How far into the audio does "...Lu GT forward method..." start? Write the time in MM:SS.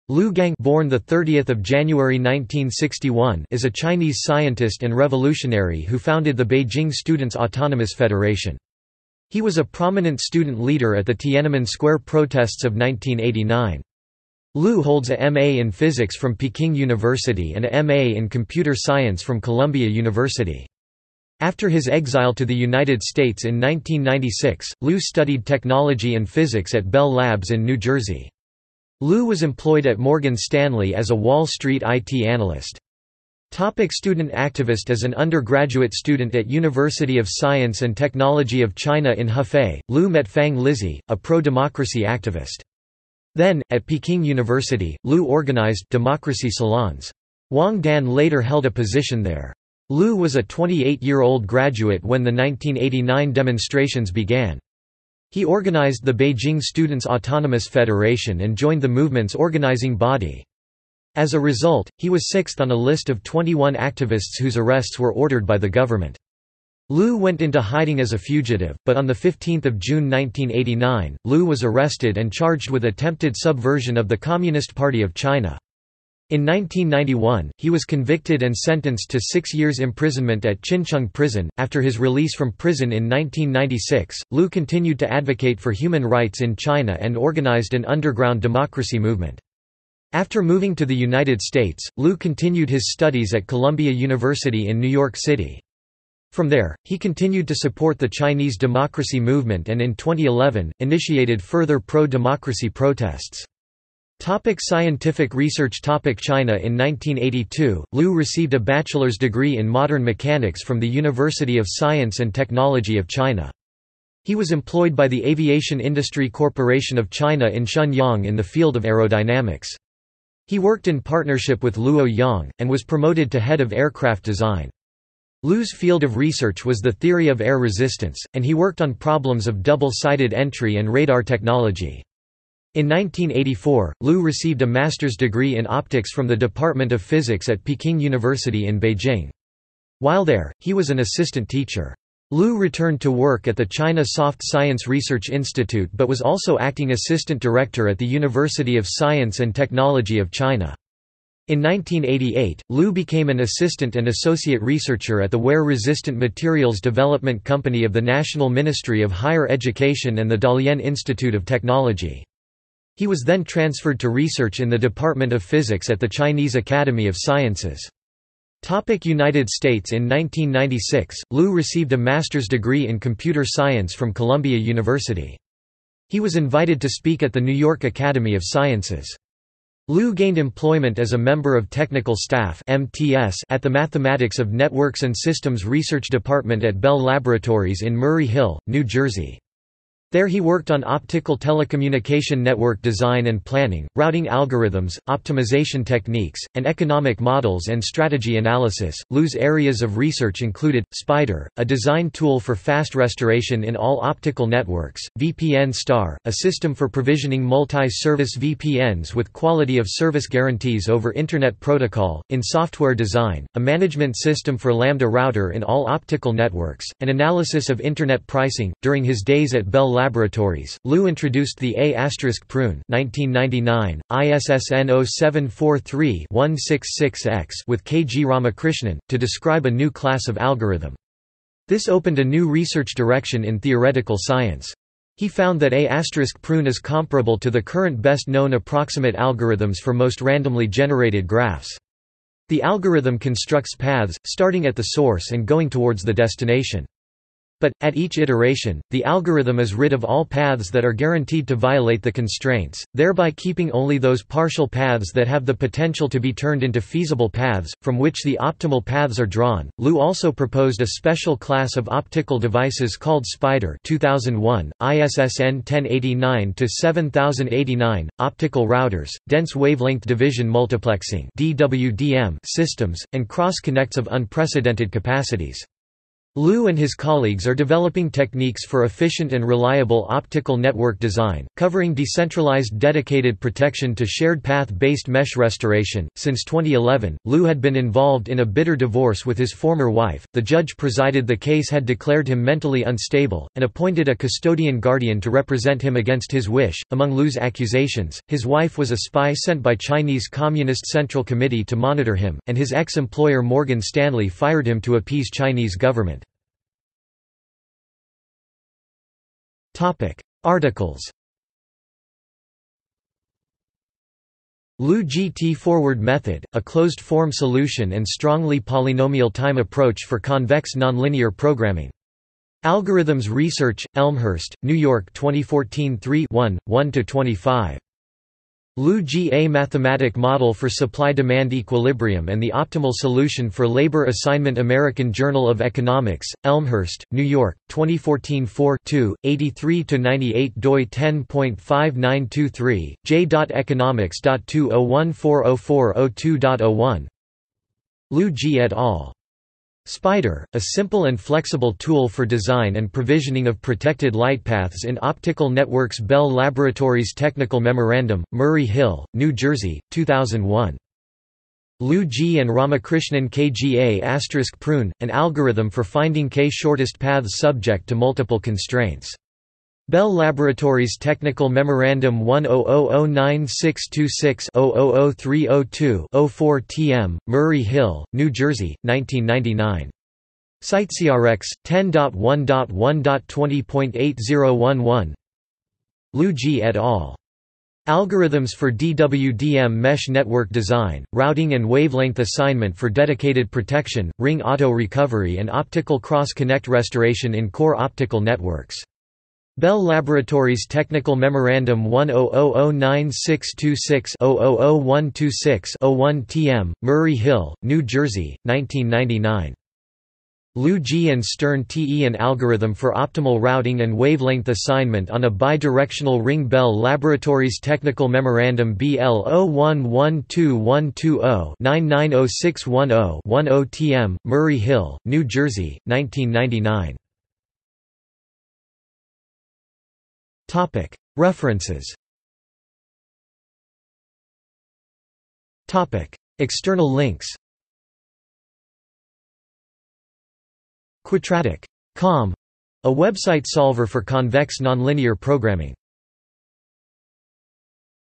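05:14.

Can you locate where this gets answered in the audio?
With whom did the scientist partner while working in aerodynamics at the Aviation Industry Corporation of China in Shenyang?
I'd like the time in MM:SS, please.
02:01.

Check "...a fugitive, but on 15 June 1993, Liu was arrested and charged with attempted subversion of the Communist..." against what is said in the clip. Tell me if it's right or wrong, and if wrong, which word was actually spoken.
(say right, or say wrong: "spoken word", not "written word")
wrong: "1989", not "1993".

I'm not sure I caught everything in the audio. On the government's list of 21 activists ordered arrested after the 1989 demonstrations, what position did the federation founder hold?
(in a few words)
sixth.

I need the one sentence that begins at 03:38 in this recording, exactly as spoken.
During his days at Bell Laboratories, Liu introduced the A** prune 1999, ISSN 0743-166X with K.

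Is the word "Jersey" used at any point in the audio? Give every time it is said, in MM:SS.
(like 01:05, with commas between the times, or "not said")
00:27, 03:08, 05:59, 06:18, 06:47, 07:05.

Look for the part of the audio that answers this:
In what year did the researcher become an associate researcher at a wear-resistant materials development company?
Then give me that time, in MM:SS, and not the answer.
02:31.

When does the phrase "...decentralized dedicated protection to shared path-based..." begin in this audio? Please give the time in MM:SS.
04:41.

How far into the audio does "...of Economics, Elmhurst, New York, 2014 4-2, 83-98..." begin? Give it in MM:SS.
05:35.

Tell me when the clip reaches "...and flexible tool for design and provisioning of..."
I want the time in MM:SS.
05:51.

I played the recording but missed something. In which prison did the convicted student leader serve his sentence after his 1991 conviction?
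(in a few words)
Qincheng Prison.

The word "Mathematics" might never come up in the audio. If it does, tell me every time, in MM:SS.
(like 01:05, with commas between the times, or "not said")
03:03, 05:29.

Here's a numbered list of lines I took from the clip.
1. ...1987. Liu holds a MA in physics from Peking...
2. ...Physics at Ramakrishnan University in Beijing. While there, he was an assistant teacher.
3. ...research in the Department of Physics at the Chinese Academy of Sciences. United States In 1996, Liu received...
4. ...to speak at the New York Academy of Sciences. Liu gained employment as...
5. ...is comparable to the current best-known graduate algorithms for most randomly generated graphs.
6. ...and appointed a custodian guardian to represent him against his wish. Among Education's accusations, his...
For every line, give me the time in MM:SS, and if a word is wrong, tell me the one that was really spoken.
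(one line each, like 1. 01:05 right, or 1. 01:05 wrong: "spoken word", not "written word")
1. 00:12 wrong: "1989", not "1987"
2. 02:17 wrong: "Peking", not "Ramakrishnan"
3. 02:44 right
4. 02:56 right
5. 03:56 wrong: "approximate", not "graduate"
6. 04:53 wrong: "Liu", not "Education".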